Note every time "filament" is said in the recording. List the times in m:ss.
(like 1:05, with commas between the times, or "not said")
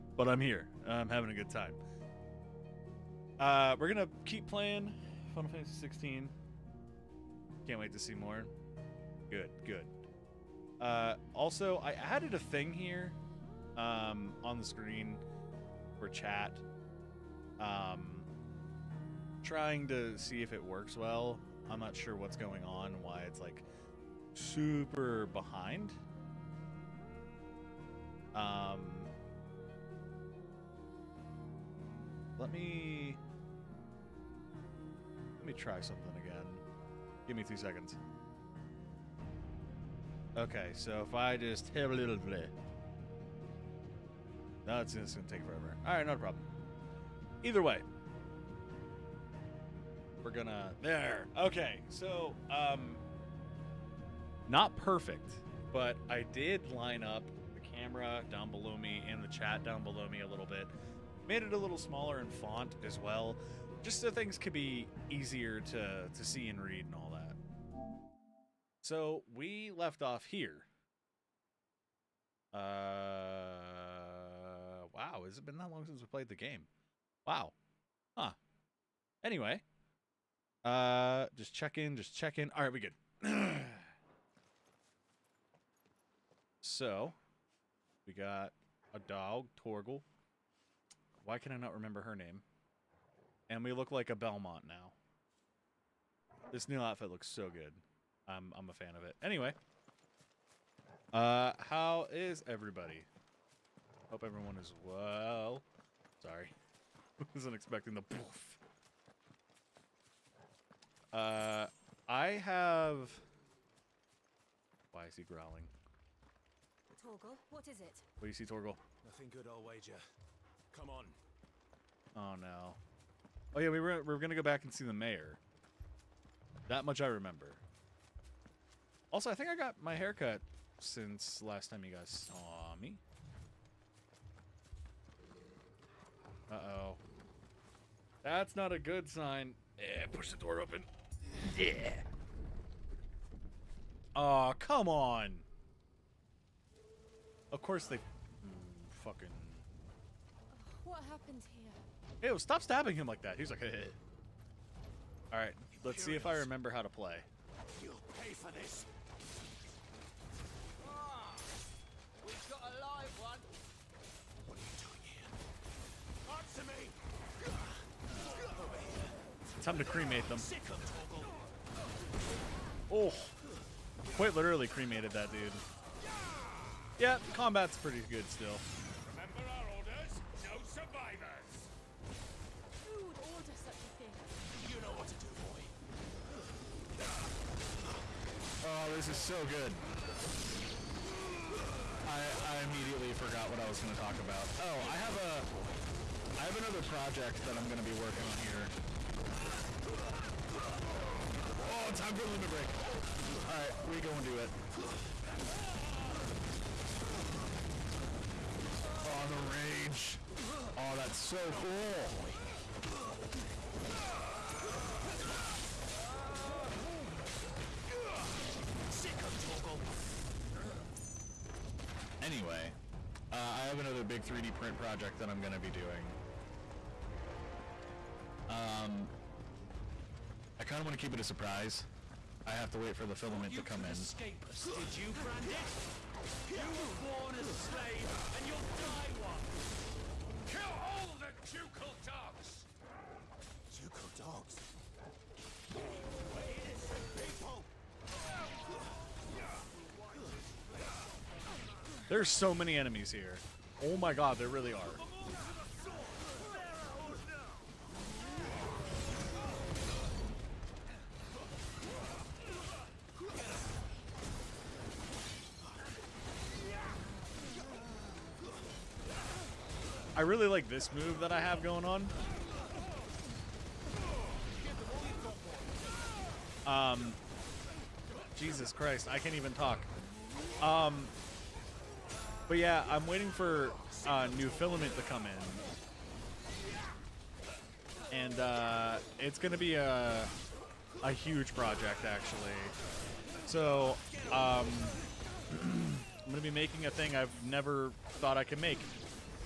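3:53, 4:44.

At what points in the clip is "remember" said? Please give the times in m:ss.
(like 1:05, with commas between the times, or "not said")
1:31, 2:07, 2:36.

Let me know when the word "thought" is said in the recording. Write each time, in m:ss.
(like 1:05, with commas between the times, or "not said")
4:58.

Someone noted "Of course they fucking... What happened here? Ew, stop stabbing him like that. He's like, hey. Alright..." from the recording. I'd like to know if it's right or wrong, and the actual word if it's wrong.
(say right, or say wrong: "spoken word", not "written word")
right.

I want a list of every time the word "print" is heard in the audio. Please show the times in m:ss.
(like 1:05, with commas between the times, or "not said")
3:44.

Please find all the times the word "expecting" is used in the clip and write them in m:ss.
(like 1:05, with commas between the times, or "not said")
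1:47.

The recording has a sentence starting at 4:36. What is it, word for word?
Um, Jesus Christ, I can't even talk.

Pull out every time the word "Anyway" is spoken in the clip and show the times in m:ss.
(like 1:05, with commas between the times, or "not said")
1:19, 1:39, 3:42.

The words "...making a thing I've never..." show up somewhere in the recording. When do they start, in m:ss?
4:56.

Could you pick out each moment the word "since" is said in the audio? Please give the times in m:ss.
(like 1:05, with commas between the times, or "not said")
1:15, 2:10.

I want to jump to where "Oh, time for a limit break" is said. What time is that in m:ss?
3:21.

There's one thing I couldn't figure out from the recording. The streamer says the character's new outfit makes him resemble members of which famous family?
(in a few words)
Belmont.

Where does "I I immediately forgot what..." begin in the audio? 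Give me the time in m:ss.
3:12.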